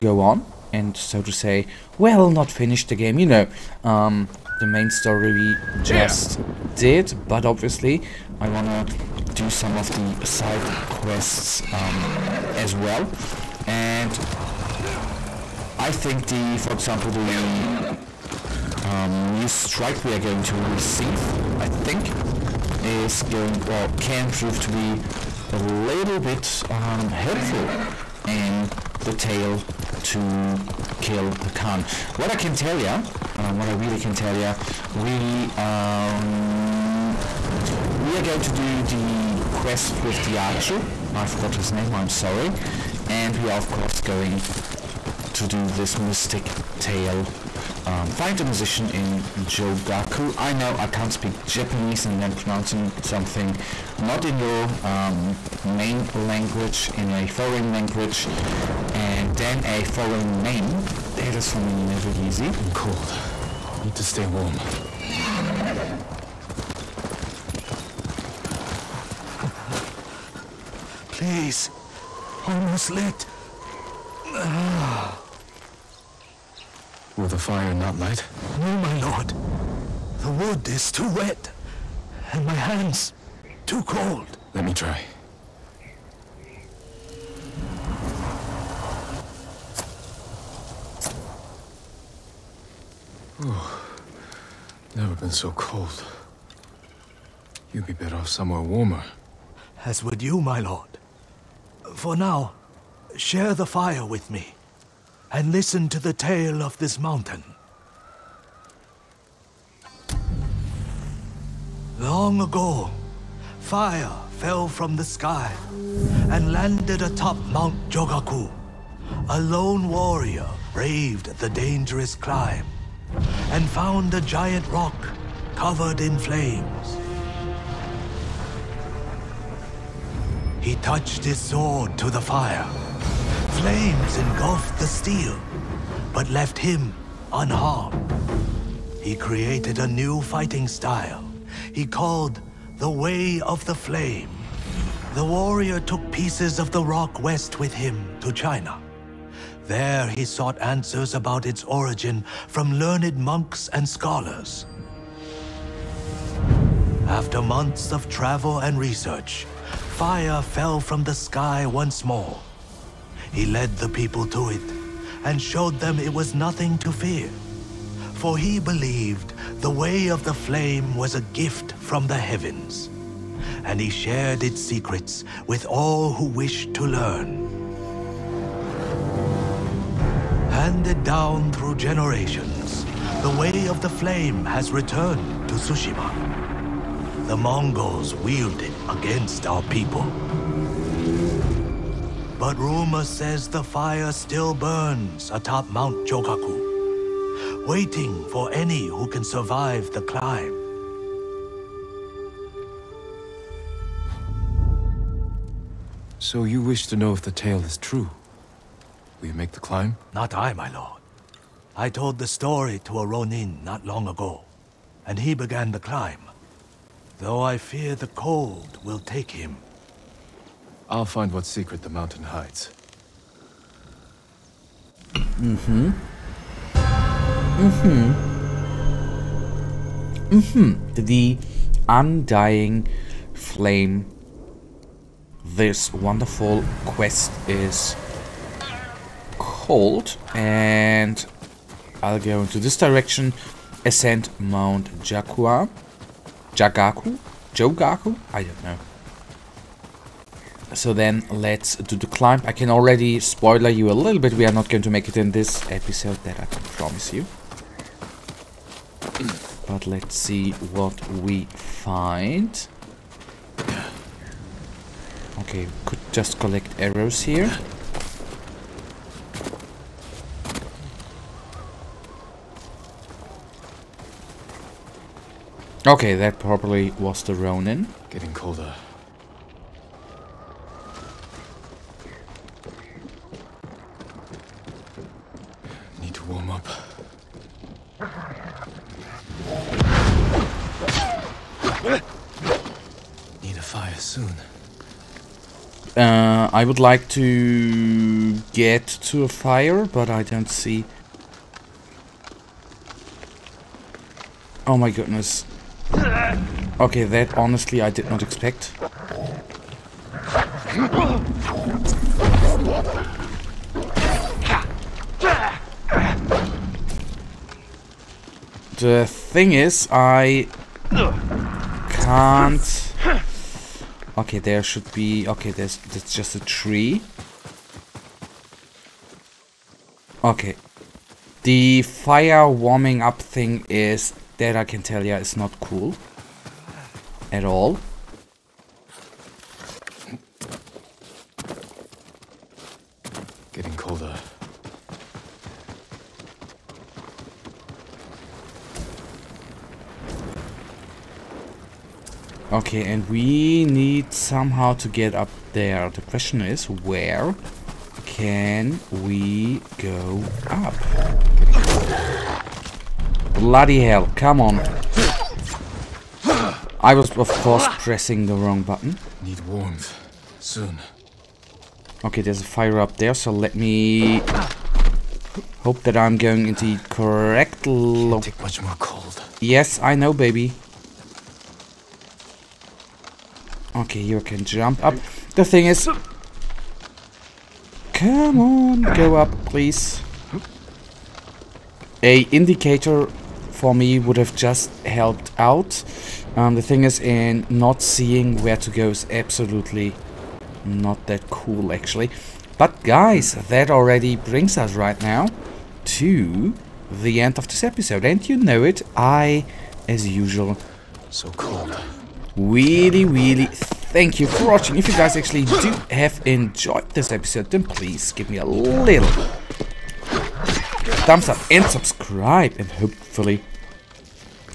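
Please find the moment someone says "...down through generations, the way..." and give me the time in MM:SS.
03:01.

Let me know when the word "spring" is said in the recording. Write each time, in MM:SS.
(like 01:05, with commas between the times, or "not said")
not said.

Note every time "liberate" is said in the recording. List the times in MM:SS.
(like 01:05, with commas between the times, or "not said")
not said.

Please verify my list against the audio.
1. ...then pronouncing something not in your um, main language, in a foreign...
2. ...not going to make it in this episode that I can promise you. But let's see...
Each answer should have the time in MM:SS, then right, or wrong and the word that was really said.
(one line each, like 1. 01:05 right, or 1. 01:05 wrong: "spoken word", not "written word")
1. 00:52 right
2. 04:14 right.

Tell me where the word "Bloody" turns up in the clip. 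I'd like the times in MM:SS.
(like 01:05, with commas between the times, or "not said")
06:03.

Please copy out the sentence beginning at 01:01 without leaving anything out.
That is for me never easy.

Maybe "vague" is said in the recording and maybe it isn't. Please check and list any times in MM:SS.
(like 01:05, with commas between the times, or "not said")
not said.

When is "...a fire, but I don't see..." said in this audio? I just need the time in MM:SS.
04:59.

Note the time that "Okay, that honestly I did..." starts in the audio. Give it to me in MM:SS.
05:06.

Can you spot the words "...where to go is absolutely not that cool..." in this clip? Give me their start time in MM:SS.
06:38.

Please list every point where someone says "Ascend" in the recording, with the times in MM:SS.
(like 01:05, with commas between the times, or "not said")
04:03.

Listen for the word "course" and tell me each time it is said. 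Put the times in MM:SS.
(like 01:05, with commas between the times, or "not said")
00:43, 06:07.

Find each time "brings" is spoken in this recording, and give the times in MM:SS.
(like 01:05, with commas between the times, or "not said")
06:44.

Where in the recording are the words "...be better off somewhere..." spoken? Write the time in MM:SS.
01:37.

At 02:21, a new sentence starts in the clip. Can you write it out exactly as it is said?
He called the Way of the Flame.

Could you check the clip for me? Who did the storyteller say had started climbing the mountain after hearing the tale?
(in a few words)
A Ronin.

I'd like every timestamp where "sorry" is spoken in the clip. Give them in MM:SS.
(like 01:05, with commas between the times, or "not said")
00:42.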